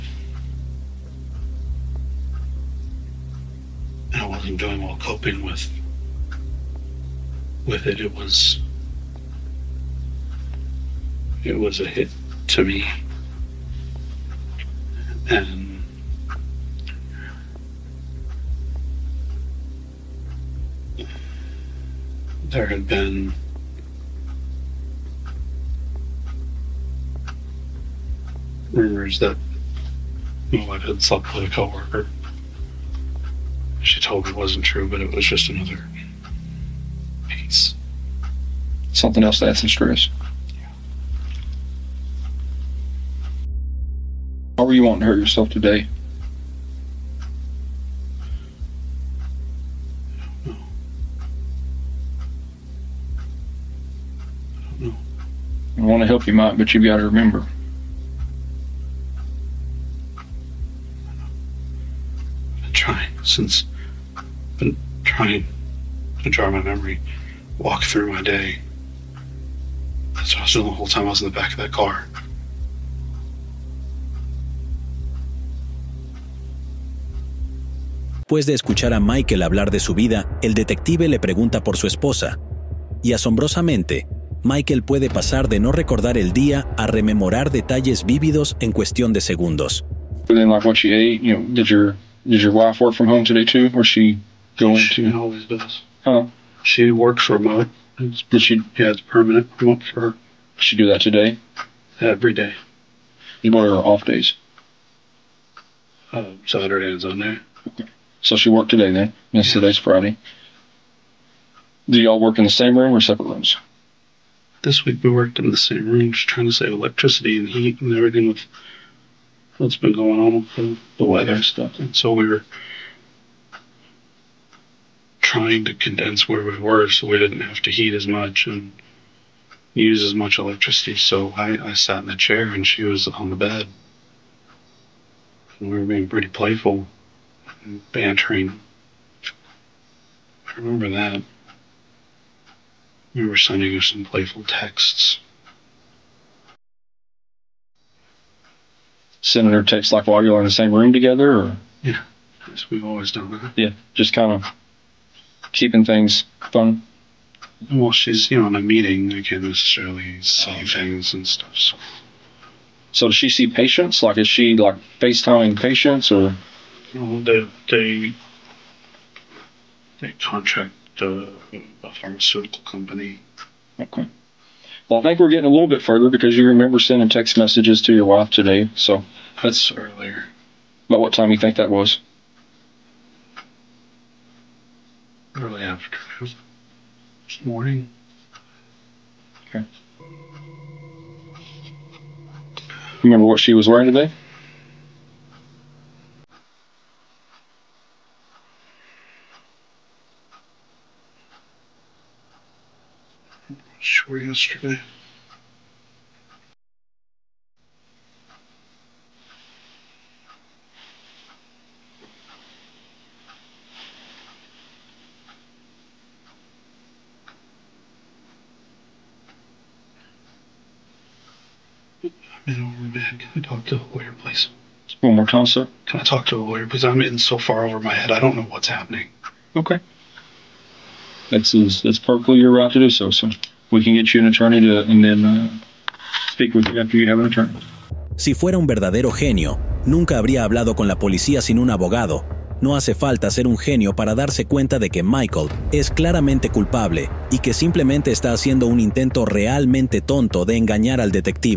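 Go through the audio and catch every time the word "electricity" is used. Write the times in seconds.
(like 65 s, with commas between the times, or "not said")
116 s, 130 s.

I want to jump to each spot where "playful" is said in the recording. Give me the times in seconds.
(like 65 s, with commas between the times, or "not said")
136 s, 144 s.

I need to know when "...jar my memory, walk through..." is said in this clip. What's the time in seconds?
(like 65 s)
66 s.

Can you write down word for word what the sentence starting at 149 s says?
Sending her texts like while you are in the same room together?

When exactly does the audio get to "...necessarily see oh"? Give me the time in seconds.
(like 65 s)
159 s.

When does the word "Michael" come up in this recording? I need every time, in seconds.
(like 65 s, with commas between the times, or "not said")
78 s, 84 s, 245 s.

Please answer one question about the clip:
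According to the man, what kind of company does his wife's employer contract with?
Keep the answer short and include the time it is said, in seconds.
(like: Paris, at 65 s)
A pharmaceutical company, at 171 s.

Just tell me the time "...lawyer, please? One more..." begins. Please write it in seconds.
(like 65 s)
223 s.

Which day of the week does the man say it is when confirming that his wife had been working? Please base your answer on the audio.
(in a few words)
Friday.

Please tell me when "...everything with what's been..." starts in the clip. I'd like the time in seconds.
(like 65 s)
117 s.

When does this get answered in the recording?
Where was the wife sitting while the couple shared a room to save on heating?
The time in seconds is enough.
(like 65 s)
133 s.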